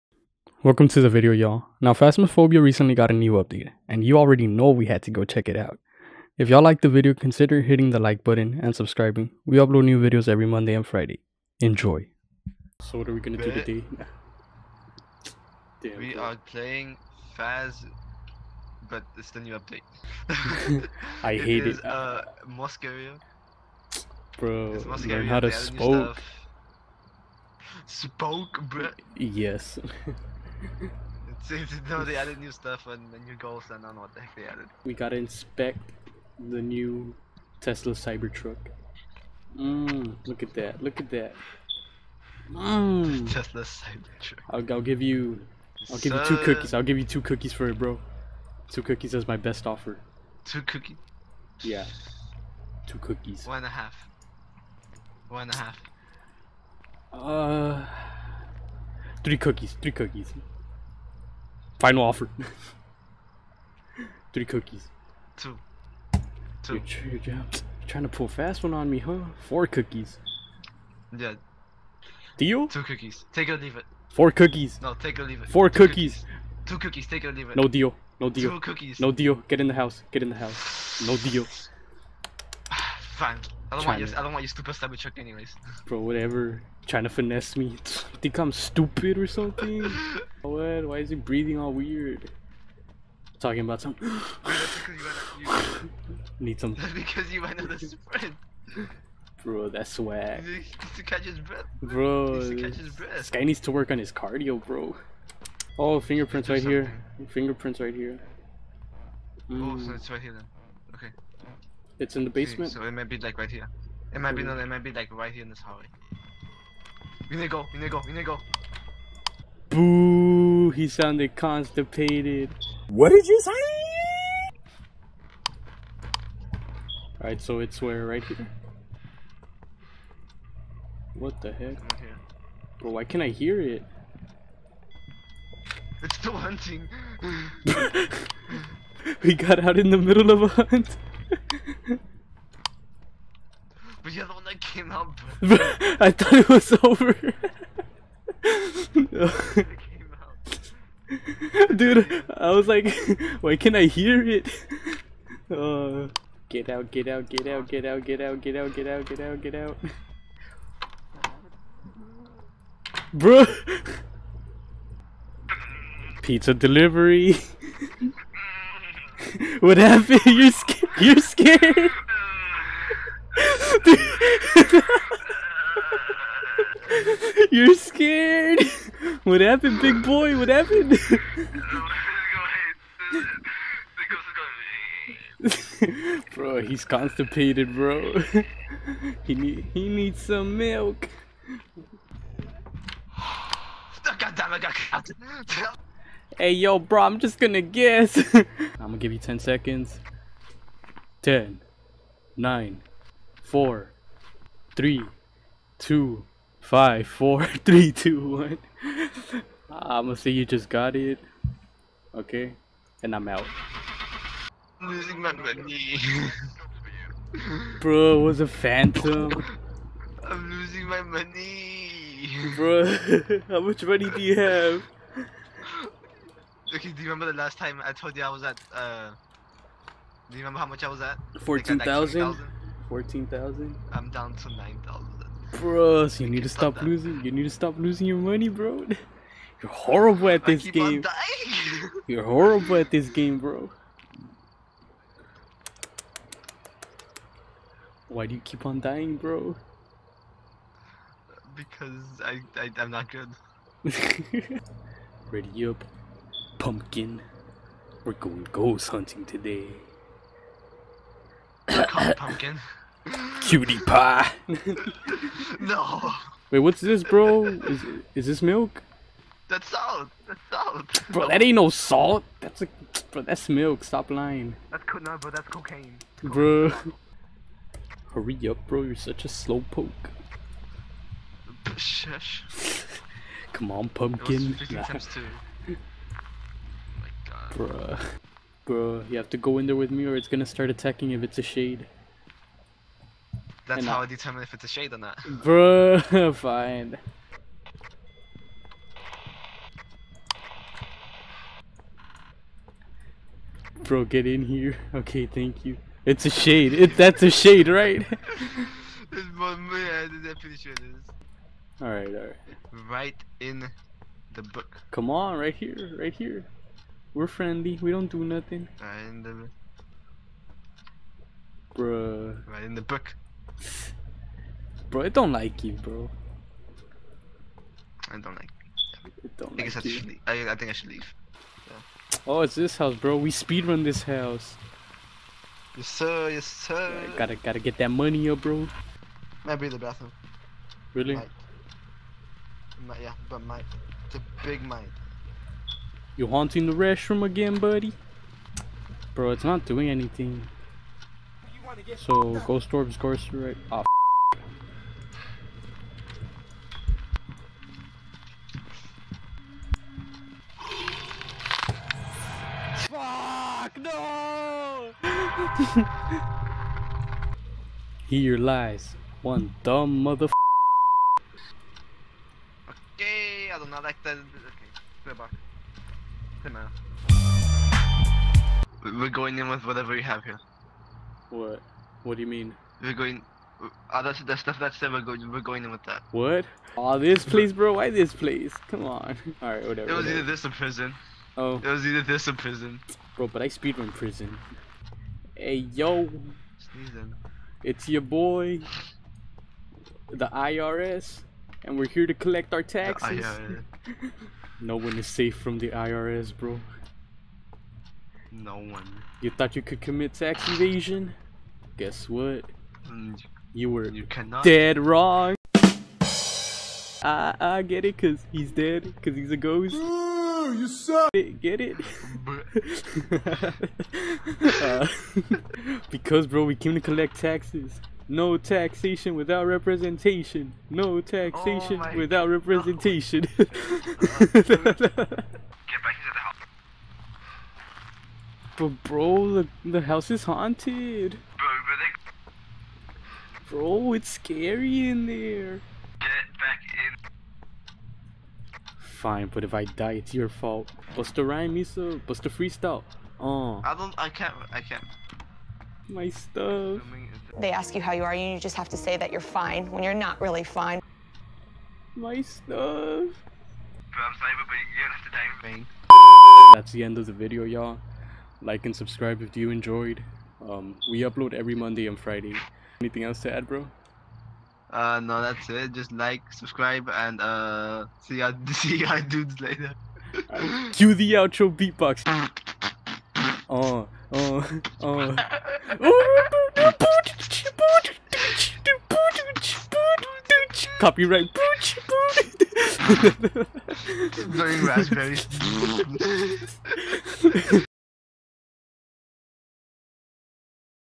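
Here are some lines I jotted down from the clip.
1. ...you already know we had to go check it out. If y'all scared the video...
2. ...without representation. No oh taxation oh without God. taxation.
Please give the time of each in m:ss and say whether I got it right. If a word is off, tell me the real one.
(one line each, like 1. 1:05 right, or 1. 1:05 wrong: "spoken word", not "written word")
1. 0:04 wrong: "liked", not "scared"
2. 7:09 wrong: "representation", not "taxation".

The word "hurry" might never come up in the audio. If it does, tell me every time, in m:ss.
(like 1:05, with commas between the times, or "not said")
4:38.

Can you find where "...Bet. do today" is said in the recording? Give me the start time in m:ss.
0:13.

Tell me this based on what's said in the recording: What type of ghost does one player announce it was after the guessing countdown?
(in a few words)
phantom.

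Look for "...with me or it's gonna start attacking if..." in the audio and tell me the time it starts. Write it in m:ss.
4:49.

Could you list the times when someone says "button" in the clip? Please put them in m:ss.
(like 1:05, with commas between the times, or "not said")
0:08.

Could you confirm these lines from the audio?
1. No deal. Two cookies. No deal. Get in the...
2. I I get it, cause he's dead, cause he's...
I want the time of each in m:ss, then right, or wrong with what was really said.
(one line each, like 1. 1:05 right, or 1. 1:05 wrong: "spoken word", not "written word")
1. 1:18 right
2. 6:57 right.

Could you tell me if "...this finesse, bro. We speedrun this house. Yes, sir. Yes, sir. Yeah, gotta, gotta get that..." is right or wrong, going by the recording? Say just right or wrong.
wrong.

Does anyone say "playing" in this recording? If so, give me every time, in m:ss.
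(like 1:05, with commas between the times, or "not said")
0:16.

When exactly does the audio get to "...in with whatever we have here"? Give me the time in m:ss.
6:19.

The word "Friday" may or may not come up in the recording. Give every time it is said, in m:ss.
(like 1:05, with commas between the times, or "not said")
0:10, 7:51.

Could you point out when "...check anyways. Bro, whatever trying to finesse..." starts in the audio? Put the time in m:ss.
1:24.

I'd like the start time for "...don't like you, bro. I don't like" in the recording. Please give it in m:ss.
5:25.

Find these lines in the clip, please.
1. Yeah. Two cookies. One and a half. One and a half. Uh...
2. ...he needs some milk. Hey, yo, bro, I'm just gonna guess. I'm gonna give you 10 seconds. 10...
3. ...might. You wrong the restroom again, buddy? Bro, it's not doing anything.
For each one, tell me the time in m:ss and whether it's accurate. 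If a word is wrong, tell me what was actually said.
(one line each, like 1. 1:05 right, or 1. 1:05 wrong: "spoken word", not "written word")
1. 0:51 right
2. 3:09 right
3. 5:44 wrong: "haunting", not "wrong".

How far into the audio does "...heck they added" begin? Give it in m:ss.
0:34.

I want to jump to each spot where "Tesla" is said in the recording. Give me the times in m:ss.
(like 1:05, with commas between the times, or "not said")
0:37, 0:43.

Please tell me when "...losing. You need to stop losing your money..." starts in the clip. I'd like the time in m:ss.
3:56.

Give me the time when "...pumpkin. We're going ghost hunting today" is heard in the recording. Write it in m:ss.
4:16.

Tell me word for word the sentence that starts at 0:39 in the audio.
Mmm, look at that, look at that.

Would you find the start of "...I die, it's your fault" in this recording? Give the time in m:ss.
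7:29.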